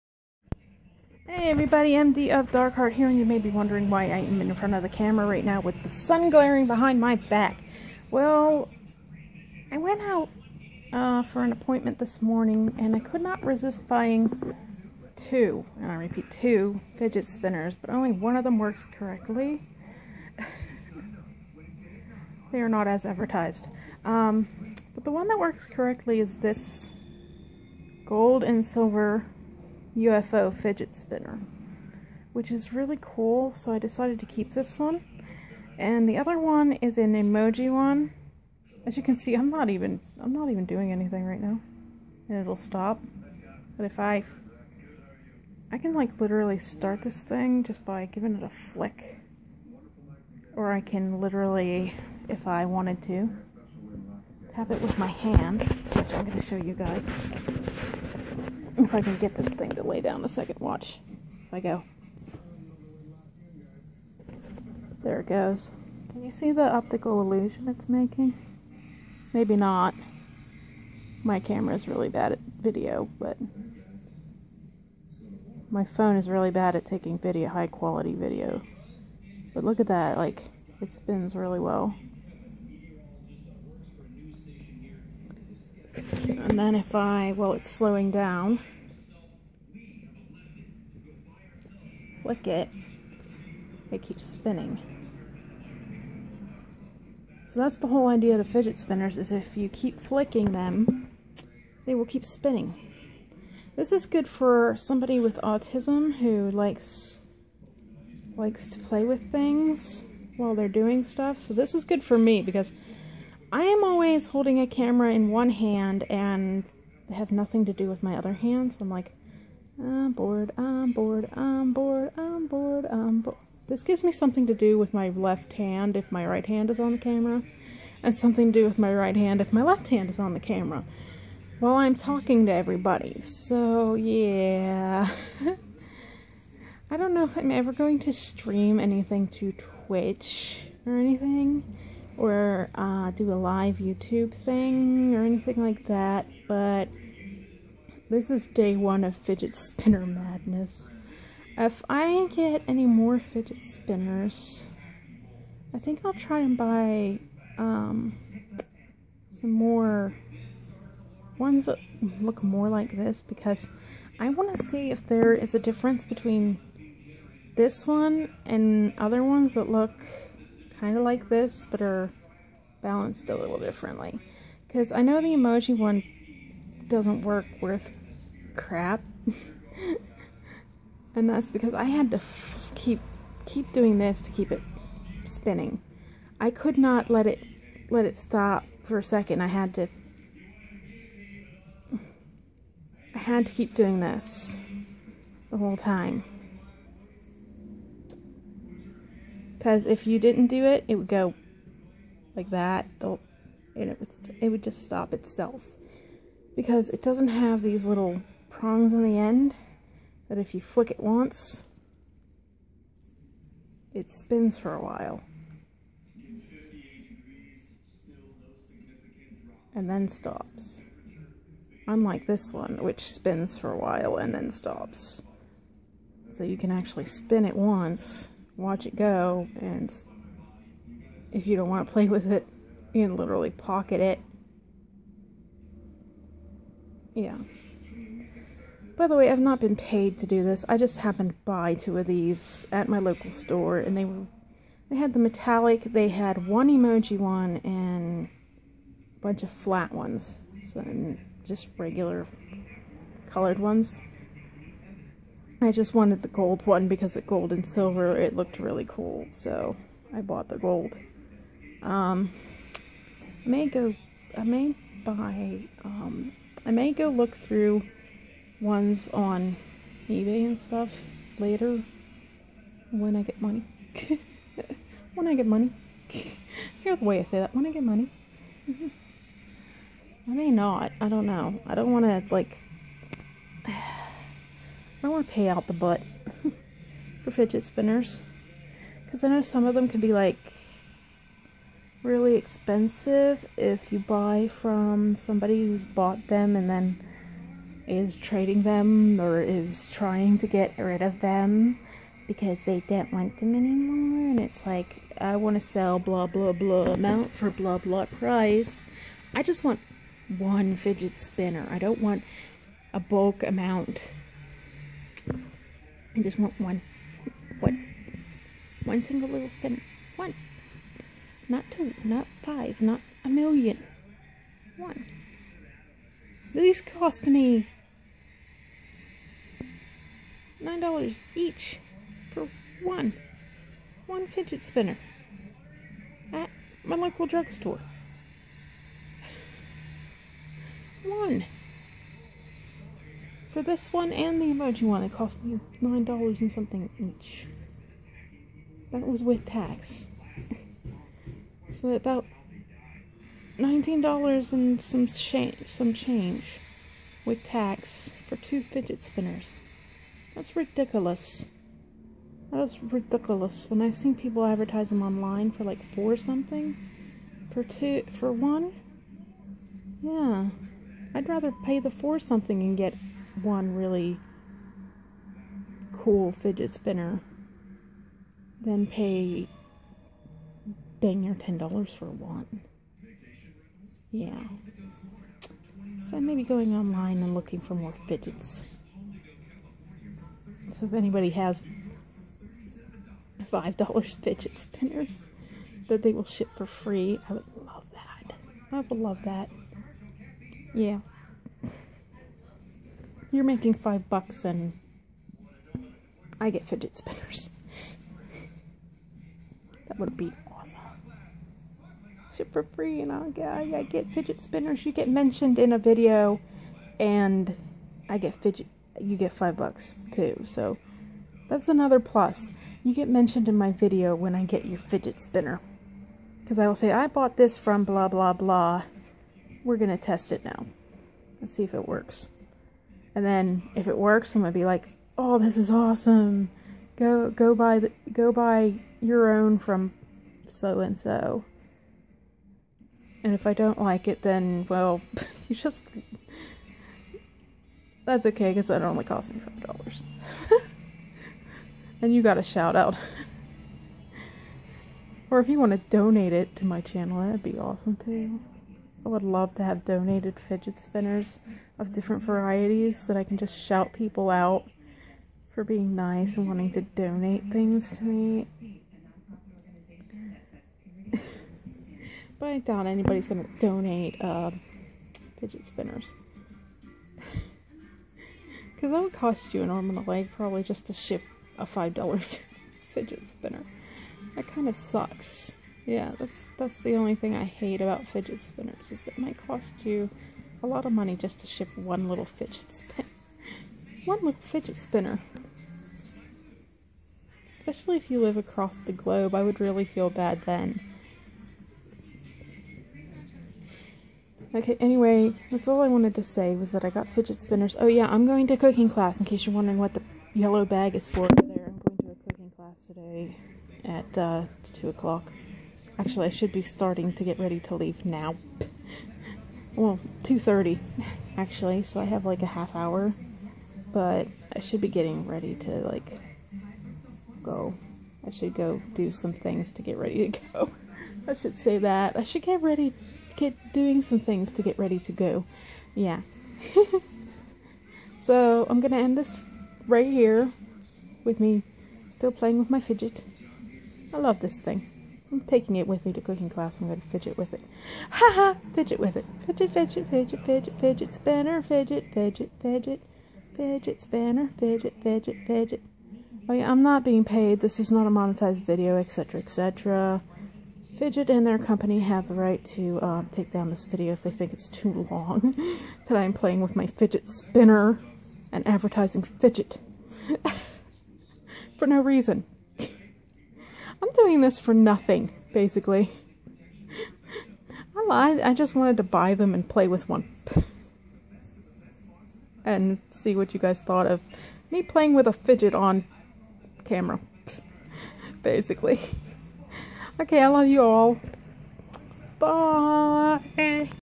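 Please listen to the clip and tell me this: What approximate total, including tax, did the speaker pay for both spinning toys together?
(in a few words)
about $19.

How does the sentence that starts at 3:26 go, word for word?
Because it doesn't have these little prongs on the end that if you flick it once, it spins for a while.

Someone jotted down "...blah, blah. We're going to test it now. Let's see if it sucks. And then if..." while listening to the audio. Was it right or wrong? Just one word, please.
wrong.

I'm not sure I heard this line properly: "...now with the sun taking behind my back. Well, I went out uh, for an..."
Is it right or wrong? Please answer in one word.
wrong.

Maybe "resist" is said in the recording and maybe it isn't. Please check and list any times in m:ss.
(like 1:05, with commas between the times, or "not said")
0:13.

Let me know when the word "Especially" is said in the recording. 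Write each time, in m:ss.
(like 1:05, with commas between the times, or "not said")
8:17.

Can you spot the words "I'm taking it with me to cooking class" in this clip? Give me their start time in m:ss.
9:05.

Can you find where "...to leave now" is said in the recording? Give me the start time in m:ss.
8:37.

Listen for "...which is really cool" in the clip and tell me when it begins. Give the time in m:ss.
0:32.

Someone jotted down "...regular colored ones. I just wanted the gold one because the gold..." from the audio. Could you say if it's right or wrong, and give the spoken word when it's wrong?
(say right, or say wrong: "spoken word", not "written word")
right.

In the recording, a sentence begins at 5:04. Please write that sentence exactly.
And it's like, I want to sell blah blah blah amount for blah blah price.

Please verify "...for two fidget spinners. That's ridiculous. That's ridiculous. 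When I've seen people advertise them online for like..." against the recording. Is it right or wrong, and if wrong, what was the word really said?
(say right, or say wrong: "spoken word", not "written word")
right.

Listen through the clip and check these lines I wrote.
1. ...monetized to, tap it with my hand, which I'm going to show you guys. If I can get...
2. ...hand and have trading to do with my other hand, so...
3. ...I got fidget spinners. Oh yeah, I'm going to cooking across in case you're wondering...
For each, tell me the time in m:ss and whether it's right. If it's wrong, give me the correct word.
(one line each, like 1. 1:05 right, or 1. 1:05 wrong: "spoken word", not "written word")
1. 0:52 wrong: "wanted", not "monetized"
2. 1:55 wrong: "nothing", not "trading"
3. 8:26 wrong: "class", not "across".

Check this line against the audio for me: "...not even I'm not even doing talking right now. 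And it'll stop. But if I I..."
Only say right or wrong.
wrong.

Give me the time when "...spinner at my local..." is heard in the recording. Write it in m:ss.
5:34.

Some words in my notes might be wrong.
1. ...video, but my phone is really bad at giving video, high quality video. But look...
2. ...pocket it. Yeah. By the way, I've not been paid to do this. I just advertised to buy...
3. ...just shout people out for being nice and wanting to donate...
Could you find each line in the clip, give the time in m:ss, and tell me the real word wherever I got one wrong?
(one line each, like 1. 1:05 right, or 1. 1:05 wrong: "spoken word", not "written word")
1. 1:12 wrong: "taking", not "giving"
2. 3:53 wrong: "happened", not "advertised"
3. 7:43 right.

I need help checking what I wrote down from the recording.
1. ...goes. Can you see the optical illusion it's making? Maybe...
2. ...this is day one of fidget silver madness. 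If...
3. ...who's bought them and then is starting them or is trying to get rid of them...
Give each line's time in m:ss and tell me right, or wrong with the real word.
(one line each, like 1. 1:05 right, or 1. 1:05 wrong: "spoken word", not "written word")
1. 1:05 right
2. 2:28 wrong: "spinner", not "silver"
3. 4:55 wrong: "trading", not "starting".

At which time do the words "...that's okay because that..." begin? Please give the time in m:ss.
7:28.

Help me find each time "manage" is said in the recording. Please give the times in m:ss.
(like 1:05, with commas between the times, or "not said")
not said.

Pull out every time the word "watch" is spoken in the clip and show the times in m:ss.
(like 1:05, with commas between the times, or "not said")
1:00, 3:48.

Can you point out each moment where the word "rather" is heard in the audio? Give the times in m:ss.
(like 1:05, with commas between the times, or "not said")
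6:11.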